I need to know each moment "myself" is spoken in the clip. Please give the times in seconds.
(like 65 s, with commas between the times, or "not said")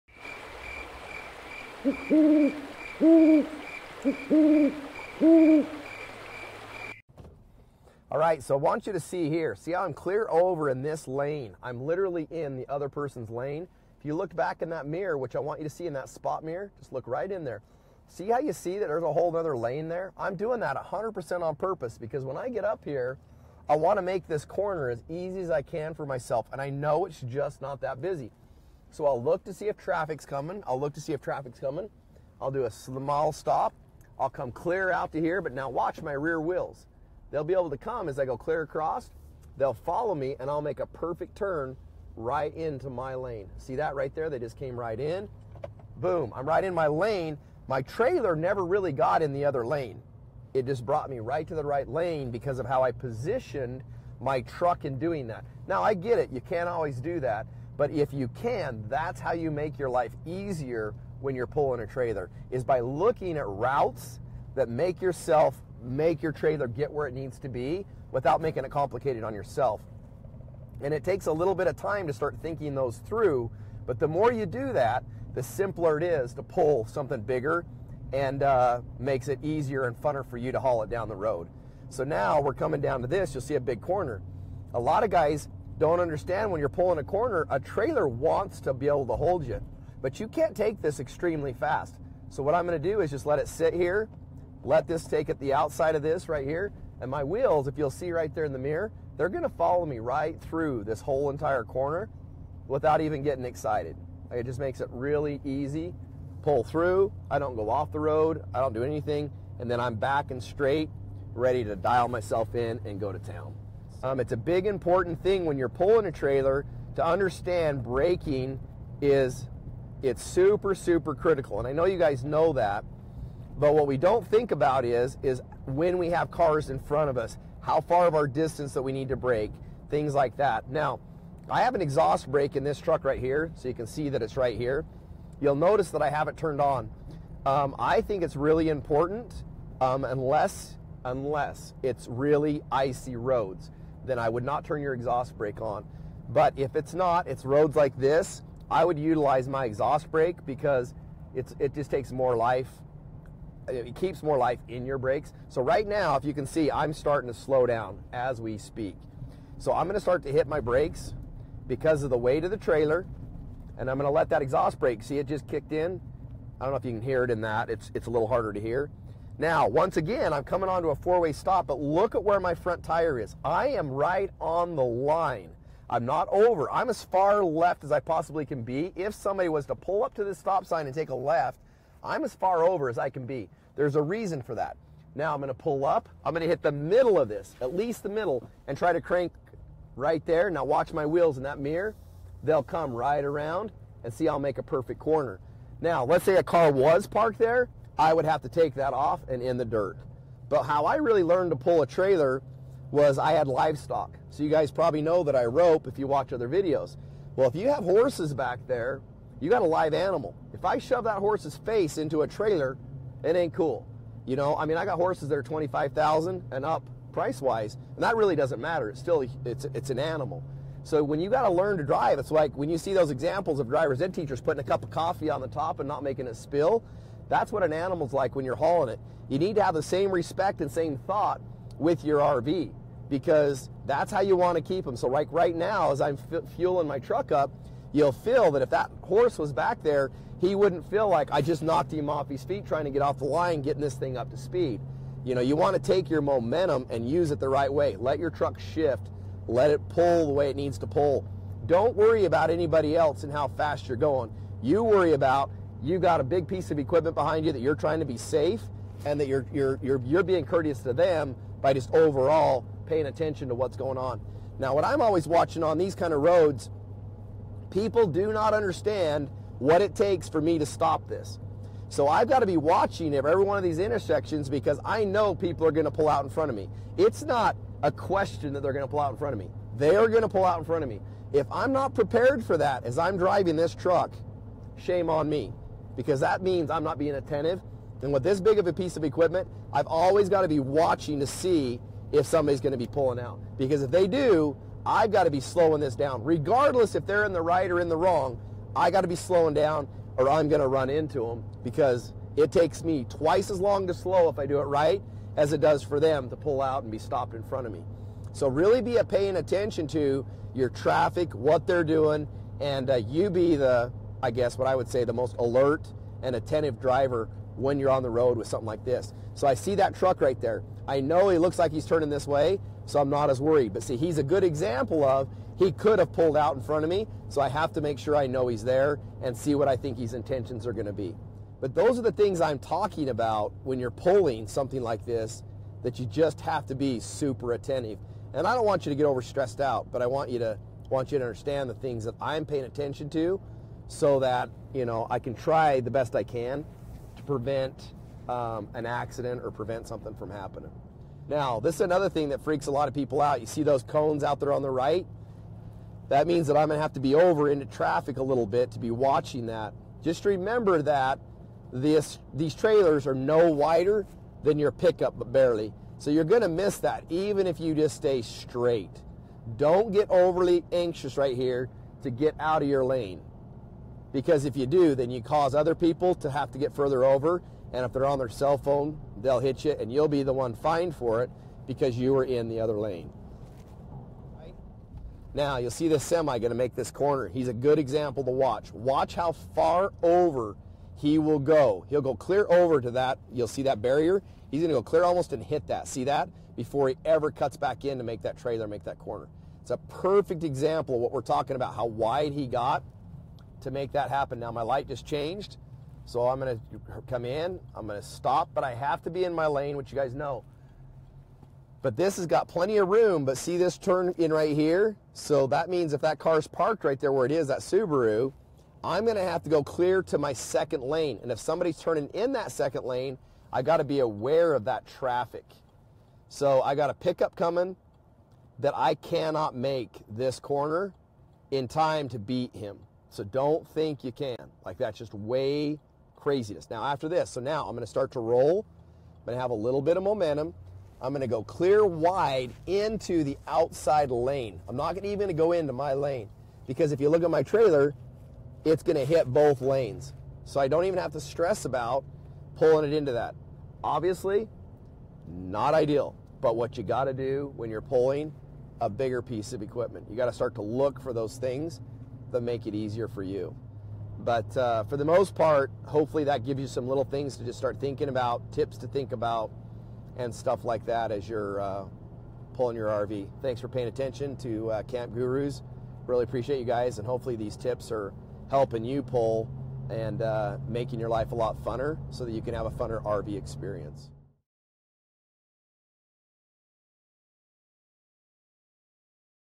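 26 s, 112 s.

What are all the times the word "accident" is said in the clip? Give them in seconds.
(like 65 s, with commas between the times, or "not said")
348 s.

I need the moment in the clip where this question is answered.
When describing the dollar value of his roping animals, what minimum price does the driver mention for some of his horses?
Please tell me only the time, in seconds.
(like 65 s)
215 s.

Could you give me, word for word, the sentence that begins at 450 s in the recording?
So I don't even have to stress about pulling it into that.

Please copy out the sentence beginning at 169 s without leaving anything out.
Now, once again, I'm coming onto a four-way stop, but look at where my front tire is.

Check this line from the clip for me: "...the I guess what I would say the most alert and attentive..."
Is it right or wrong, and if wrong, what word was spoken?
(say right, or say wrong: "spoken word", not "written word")
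right.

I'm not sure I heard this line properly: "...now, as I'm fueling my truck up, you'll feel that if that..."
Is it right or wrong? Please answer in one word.
right.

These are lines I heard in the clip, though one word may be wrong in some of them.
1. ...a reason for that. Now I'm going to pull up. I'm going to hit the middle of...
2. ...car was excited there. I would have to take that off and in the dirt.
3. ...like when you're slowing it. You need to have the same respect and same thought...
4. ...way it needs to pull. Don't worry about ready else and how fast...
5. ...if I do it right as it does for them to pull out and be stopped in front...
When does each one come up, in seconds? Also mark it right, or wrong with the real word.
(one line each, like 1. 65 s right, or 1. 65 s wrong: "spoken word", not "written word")
1. 183 s right
2. 196 s wrong: "parked", not "excited"
3. 228 s wrong: "hauling", not "slowing"
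4. 250 s wrong: "anybody", not "ready"
5. 304 s right.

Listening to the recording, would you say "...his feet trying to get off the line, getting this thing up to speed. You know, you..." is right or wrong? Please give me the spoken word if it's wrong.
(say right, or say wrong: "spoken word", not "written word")
right.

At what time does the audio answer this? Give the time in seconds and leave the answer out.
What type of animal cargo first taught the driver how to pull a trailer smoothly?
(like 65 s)
203 s.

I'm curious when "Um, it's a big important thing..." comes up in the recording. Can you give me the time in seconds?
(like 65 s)
114 s.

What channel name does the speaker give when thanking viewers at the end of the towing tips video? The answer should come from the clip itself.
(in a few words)
Camp Gurus.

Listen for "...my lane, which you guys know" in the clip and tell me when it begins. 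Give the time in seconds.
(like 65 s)
409 s.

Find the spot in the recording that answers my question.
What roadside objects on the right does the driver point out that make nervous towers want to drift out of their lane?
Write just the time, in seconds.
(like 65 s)
353 s.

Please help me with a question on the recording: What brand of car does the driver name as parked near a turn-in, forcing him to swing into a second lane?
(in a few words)
Subaru.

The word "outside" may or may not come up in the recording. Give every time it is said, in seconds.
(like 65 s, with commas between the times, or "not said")
95 s, 443 s.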